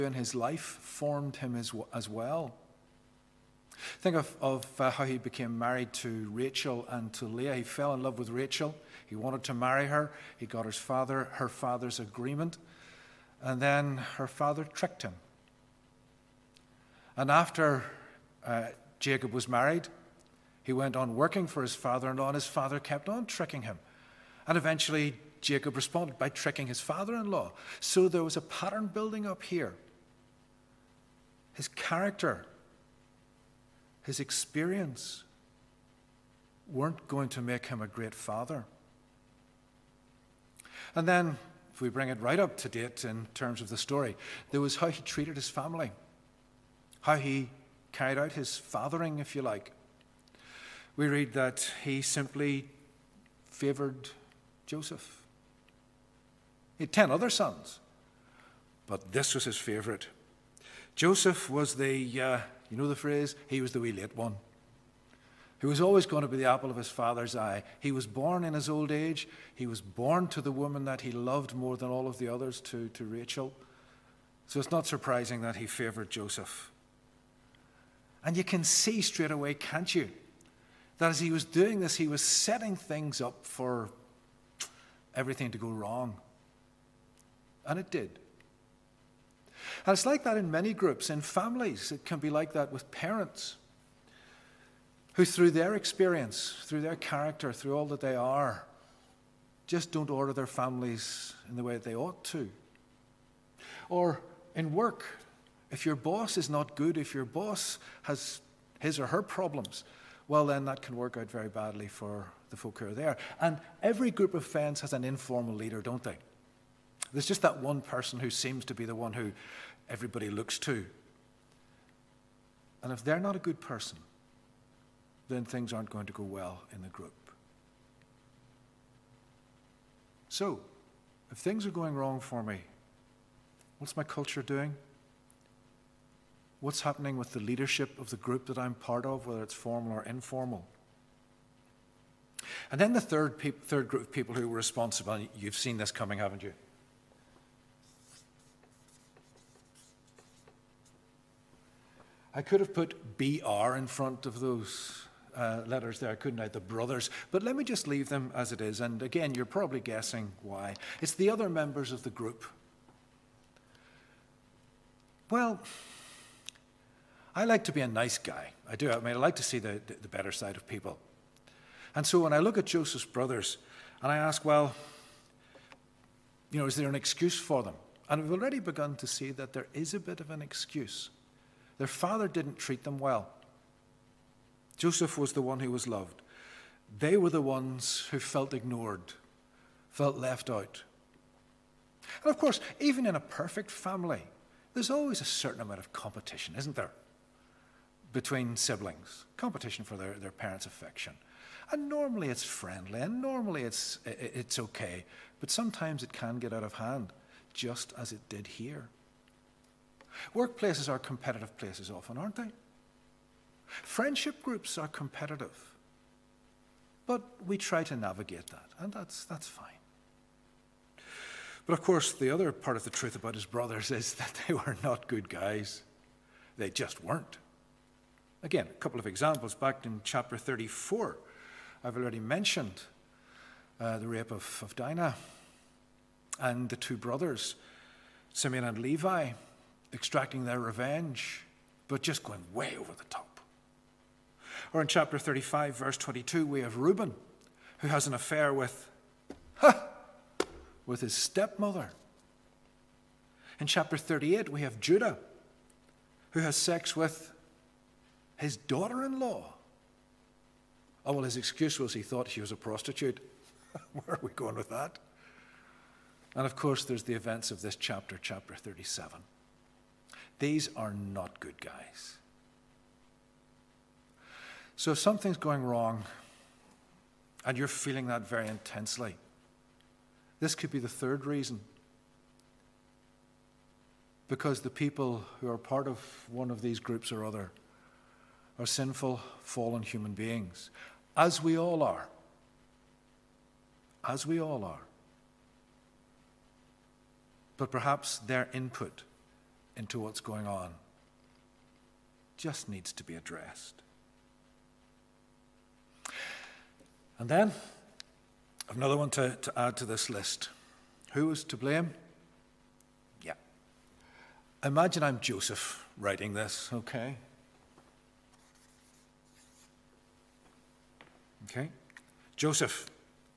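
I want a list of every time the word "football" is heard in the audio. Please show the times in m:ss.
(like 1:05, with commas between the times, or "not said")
not said.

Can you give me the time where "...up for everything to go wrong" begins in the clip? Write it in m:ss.
1:23.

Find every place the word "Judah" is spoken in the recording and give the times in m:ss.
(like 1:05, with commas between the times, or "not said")
4:14.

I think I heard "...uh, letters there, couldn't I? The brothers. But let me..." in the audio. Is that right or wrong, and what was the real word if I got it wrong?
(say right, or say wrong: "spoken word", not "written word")
right.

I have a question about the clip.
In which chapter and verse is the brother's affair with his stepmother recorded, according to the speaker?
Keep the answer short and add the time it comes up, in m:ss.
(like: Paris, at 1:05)
Chapter 35, verse 22, at 4:04.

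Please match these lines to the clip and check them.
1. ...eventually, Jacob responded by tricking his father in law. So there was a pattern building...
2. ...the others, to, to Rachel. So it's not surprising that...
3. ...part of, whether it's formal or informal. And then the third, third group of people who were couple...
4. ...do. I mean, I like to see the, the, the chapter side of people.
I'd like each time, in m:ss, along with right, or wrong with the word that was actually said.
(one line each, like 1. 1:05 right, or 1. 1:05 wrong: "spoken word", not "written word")
1. 0:24 right
2. 1:12 right
3. 2:18 wrong: "responsible", not "couple"
4. 2:48 wrong: "better", not "chapter".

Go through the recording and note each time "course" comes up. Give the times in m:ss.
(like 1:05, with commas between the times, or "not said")
3:12, 3:41, 4:26.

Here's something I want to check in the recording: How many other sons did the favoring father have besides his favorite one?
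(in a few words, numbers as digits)
10.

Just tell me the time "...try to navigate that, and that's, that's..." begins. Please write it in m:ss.
3:37.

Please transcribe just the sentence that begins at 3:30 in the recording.
Workplaces are competitive places often, aren't they?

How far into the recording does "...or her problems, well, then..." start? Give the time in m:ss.
1:48.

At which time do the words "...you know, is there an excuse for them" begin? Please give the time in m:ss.
2:56.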